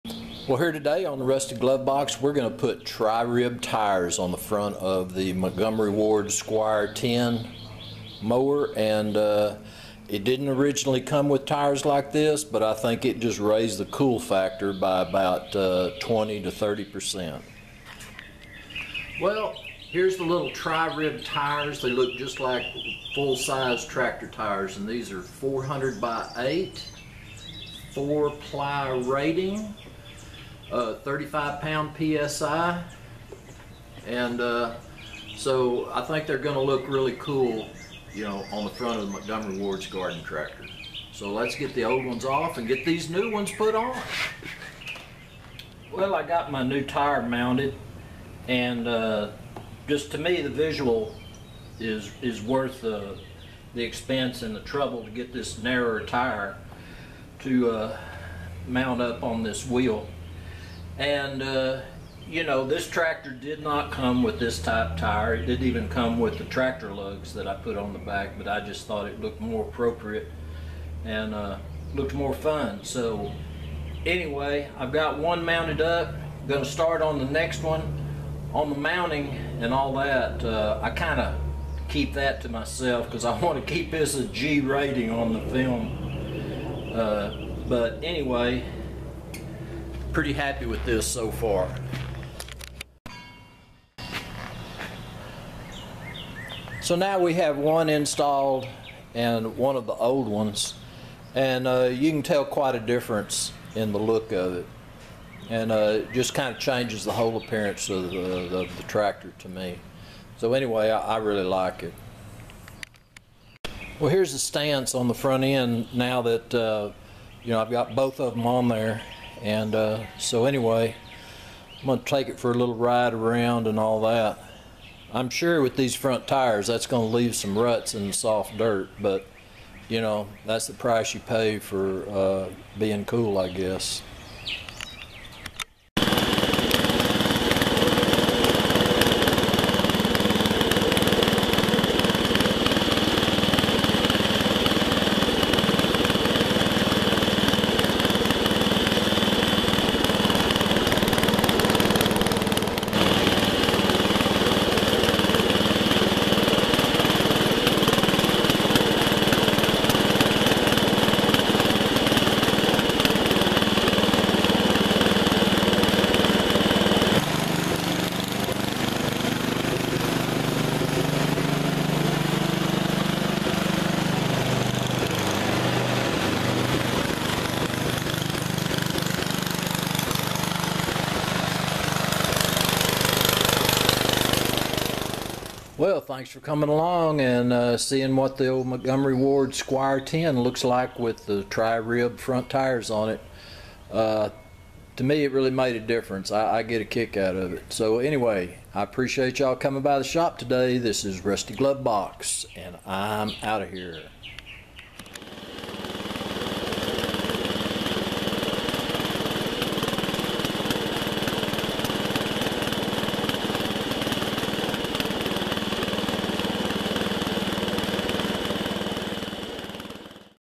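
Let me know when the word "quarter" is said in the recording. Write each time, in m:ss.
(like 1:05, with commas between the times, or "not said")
not said.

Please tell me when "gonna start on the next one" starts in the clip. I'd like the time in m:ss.
1:16.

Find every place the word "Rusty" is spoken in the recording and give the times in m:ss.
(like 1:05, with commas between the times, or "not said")
0:01, 3:21.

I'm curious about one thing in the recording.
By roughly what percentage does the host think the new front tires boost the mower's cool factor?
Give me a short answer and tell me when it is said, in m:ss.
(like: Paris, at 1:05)
20 to 30%, at 0:16.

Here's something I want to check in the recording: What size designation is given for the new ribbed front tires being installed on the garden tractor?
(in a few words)
400 by 8.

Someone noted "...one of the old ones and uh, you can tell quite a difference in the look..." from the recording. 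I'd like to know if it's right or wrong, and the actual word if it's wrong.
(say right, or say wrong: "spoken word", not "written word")
right.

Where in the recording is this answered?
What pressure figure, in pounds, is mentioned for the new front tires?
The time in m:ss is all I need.
0:30.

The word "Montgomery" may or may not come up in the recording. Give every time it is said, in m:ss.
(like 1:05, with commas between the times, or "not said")
0:05, 0:39, 3:08.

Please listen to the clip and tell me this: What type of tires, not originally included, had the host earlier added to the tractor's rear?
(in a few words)
tractor lugs.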